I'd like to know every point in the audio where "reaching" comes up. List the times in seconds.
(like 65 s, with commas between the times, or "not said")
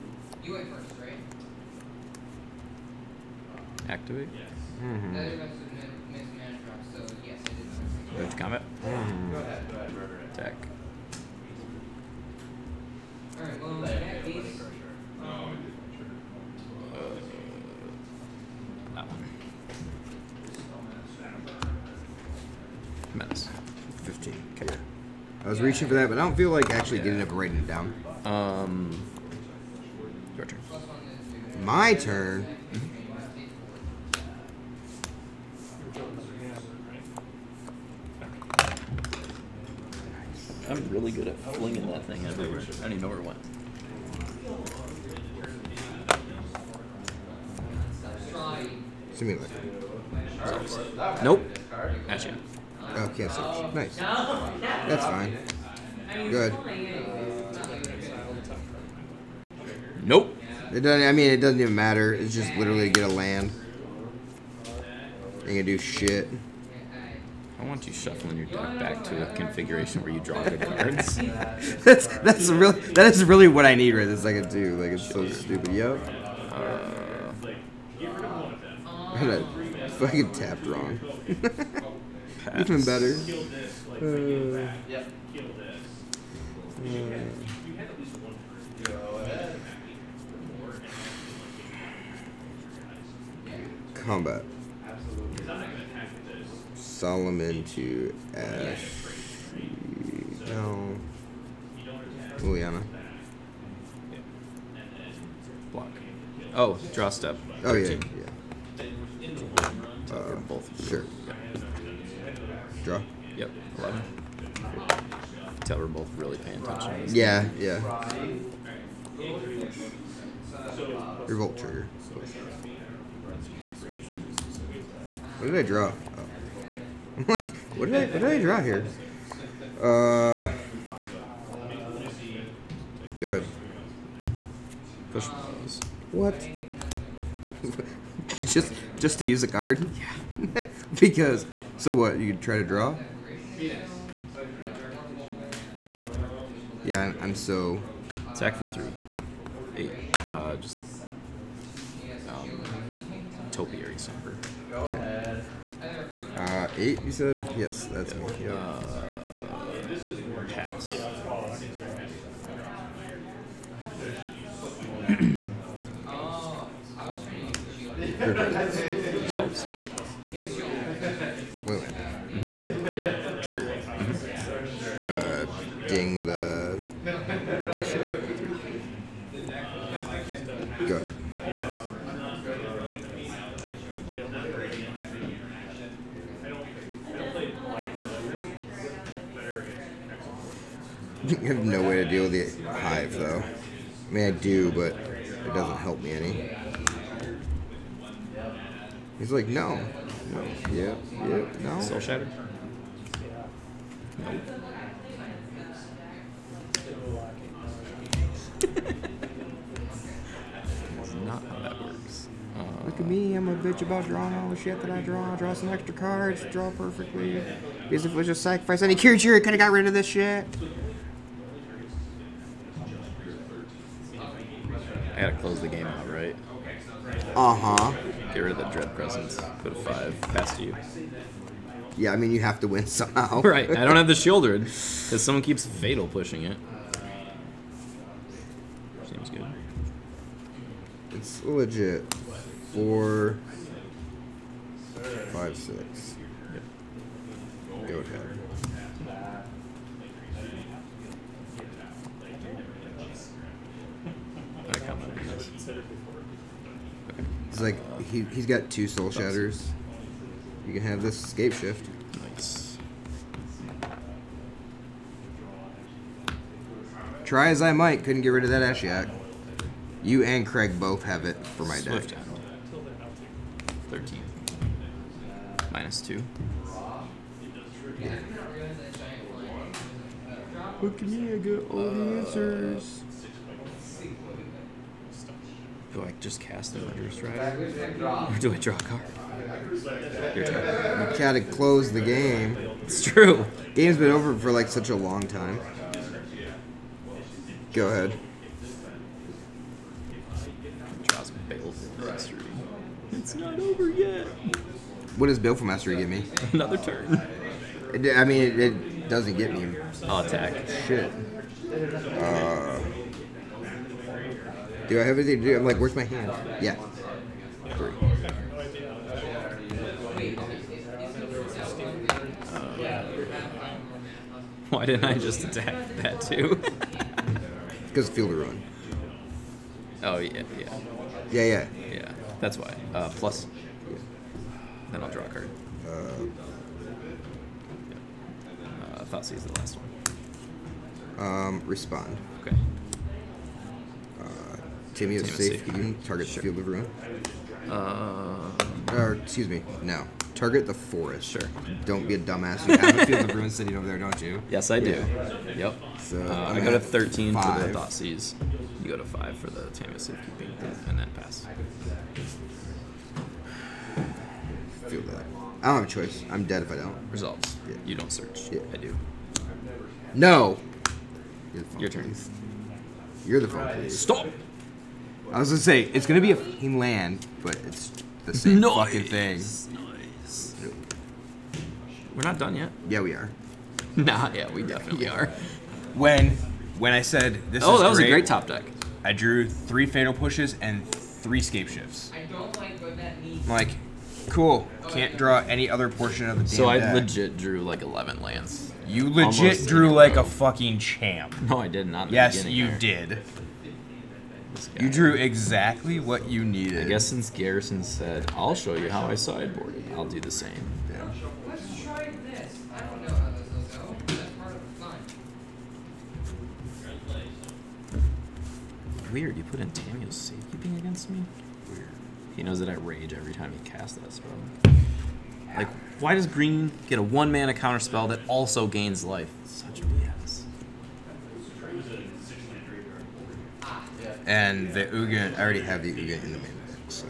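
25 s.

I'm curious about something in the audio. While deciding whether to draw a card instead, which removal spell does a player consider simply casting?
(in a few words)
Murderous Strike.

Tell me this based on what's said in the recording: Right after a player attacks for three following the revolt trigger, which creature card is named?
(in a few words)
Topiary Stomper.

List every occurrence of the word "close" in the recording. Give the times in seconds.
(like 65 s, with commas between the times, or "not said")
225 s, 291 s.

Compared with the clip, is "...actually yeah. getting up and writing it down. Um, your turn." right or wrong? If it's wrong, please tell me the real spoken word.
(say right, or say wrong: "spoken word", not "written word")
right.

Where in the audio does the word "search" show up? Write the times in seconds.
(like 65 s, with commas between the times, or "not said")
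53 s, 368 s.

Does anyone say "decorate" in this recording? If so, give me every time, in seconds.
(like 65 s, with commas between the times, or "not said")
not said.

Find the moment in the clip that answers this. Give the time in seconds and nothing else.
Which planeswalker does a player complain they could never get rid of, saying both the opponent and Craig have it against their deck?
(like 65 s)
268 s.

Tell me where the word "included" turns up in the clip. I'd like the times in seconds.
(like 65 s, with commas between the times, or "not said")
not said.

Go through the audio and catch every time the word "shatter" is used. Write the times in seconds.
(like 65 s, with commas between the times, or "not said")
201 s, 259 s.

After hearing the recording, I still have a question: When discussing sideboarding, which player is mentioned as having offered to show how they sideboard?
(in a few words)
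Garrison.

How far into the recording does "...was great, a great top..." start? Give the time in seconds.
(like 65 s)
387 s.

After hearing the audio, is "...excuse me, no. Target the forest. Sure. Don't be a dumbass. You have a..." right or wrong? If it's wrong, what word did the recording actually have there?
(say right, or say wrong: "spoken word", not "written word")
right.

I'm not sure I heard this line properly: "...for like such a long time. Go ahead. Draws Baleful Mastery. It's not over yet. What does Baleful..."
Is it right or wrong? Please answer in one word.
right.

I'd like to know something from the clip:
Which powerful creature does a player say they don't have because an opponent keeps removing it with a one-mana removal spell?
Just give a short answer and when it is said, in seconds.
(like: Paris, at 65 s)
Sheoldred, at 234 s.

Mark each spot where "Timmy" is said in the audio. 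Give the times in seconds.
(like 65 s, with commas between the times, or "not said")
344 s.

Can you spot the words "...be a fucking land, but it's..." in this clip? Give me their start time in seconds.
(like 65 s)
376 s.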